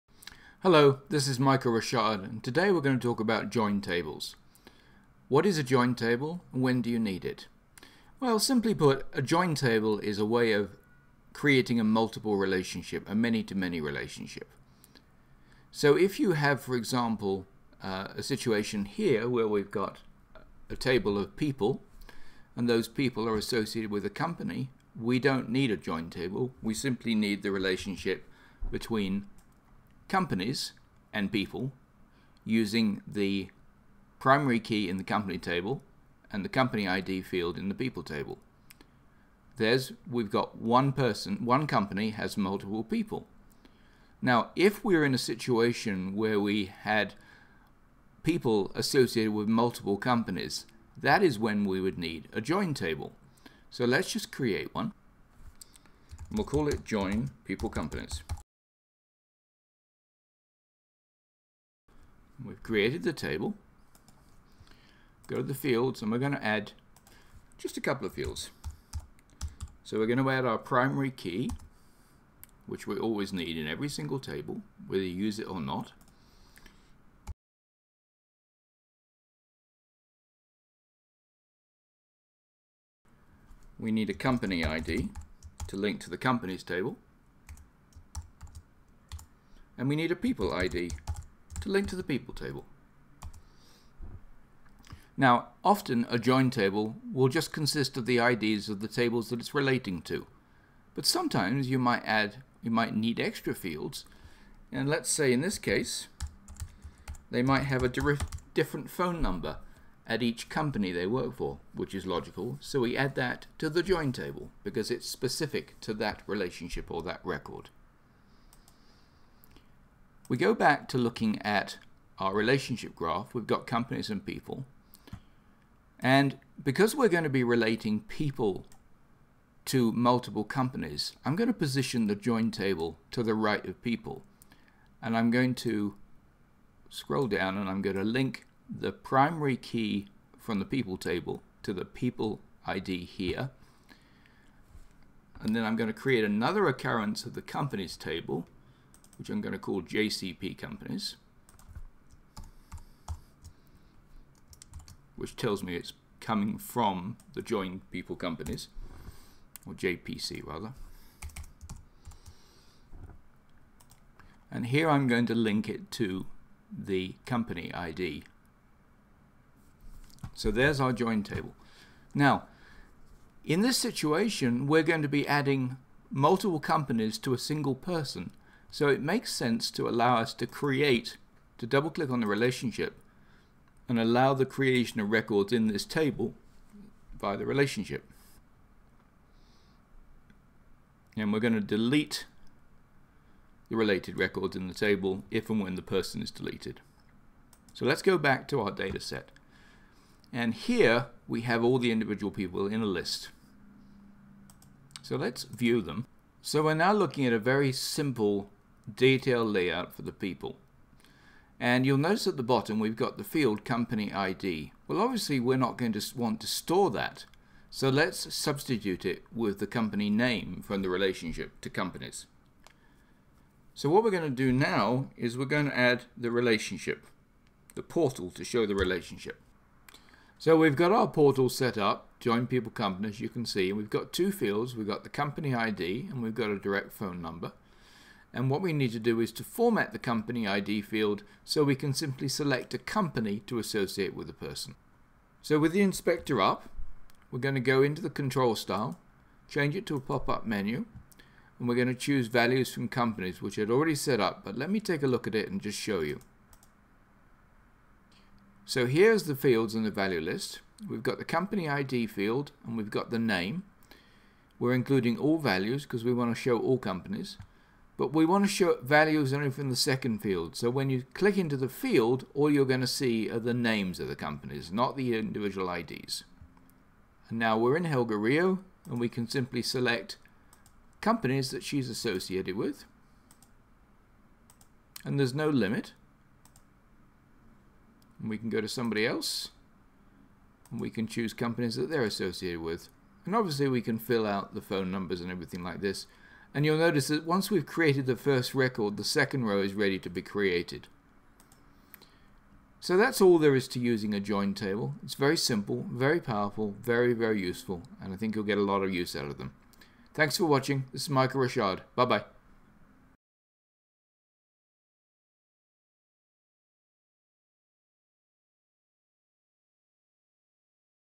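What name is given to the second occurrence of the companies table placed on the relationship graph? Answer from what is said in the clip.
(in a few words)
JCP companies.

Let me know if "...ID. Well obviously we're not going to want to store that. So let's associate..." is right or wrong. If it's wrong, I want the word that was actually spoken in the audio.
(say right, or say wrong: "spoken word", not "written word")
wrong: "substitute", not "associate".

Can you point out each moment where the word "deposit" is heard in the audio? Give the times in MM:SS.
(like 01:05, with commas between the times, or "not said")
not said.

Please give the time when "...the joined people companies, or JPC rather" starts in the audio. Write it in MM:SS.
02:37.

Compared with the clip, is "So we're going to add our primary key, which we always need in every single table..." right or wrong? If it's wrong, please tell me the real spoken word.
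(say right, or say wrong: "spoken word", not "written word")
right.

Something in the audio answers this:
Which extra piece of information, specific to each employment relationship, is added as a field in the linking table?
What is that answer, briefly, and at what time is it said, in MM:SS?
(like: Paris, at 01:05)
direct phone number, at 03:56.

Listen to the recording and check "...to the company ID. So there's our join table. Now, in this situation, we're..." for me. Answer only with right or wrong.
right.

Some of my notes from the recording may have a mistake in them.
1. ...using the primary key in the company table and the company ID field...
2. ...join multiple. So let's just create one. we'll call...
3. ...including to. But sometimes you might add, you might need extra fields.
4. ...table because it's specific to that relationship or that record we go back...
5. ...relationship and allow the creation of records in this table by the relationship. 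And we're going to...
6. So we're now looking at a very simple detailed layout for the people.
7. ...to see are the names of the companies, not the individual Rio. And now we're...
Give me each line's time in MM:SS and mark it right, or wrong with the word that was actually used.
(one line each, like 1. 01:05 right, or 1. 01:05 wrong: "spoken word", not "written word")
1. 00:32 right
2. 00:52 wrong: "table", not "multiple"
3. 01:39 wrong: "relating", not "including"
4. 01:54 right
5. 03:02 right
6. 03:26 right
7. 04:32 wrong: "IDs", not "Rio".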